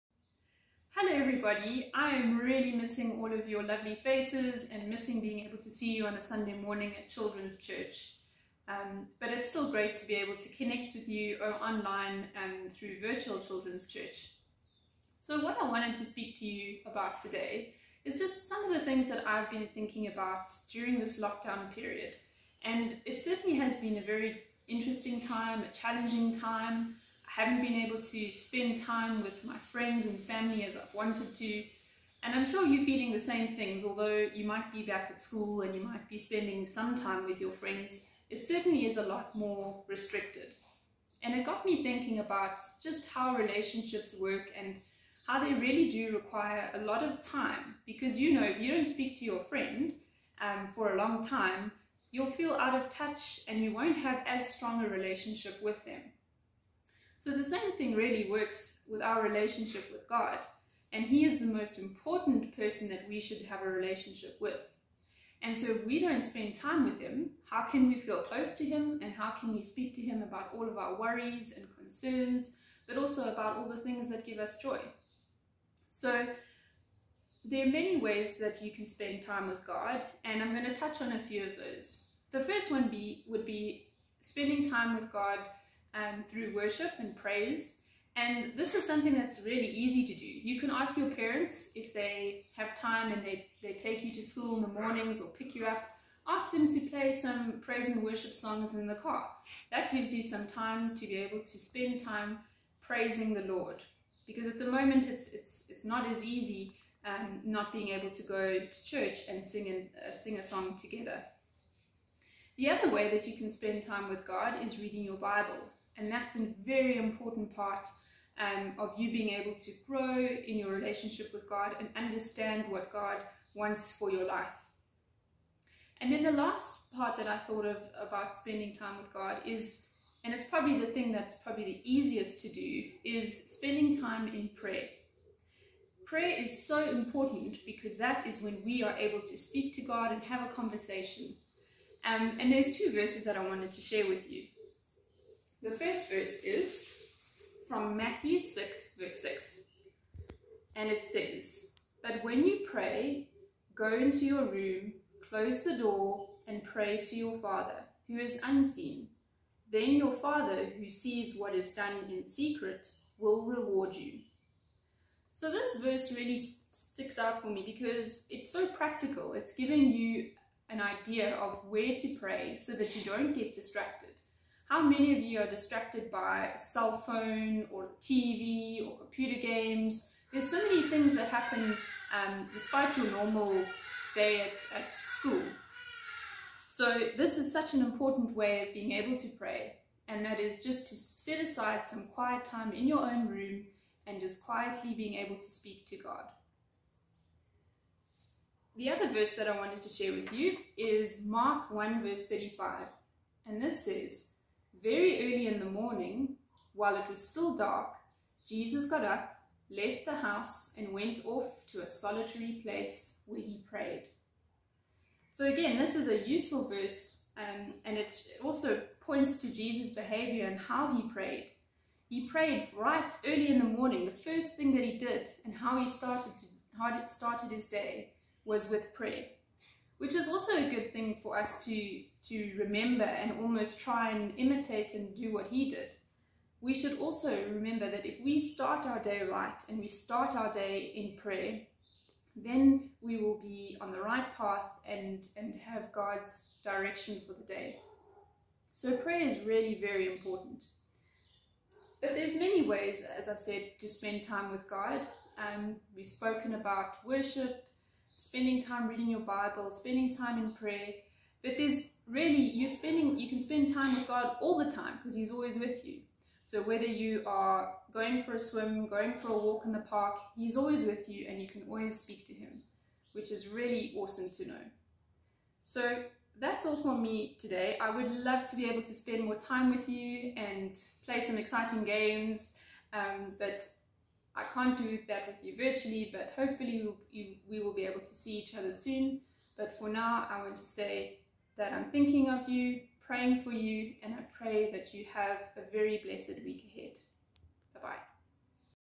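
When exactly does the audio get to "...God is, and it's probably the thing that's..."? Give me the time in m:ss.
2:09.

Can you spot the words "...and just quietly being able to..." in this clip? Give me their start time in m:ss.
3:14.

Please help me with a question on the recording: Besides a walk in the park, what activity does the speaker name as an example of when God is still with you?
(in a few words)
Going for a swim.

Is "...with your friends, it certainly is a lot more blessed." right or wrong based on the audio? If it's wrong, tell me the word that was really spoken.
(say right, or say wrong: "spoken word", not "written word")
wrong: "restricted", not "blessed".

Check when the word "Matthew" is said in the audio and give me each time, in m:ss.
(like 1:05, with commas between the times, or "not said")
2:27.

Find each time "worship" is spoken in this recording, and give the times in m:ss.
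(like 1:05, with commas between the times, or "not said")
1:26, 1:38, 4:17.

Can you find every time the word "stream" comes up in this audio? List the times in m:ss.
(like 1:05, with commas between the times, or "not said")
not said.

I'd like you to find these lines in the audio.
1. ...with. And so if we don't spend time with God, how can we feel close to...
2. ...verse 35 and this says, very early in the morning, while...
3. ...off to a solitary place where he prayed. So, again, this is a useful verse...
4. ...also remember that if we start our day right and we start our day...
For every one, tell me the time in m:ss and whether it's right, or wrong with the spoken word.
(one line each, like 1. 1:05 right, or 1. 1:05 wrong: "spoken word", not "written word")
1. 1:04 wrong: "Him", not "God"
2. 3:22 right
3. 3:31 right
4. 3:56 right.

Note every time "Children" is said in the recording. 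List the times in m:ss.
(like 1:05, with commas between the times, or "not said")
0:07, 0:13.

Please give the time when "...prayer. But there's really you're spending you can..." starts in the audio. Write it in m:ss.
4:20.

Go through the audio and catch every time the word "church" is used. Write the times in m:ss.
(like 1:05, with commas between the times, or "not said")
0:07, 0:13, 1:48.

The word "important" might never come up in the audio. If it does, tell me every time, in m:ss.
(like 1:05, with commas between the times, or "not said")
1:01, 1:56, 2:16, 3:07, 4:10.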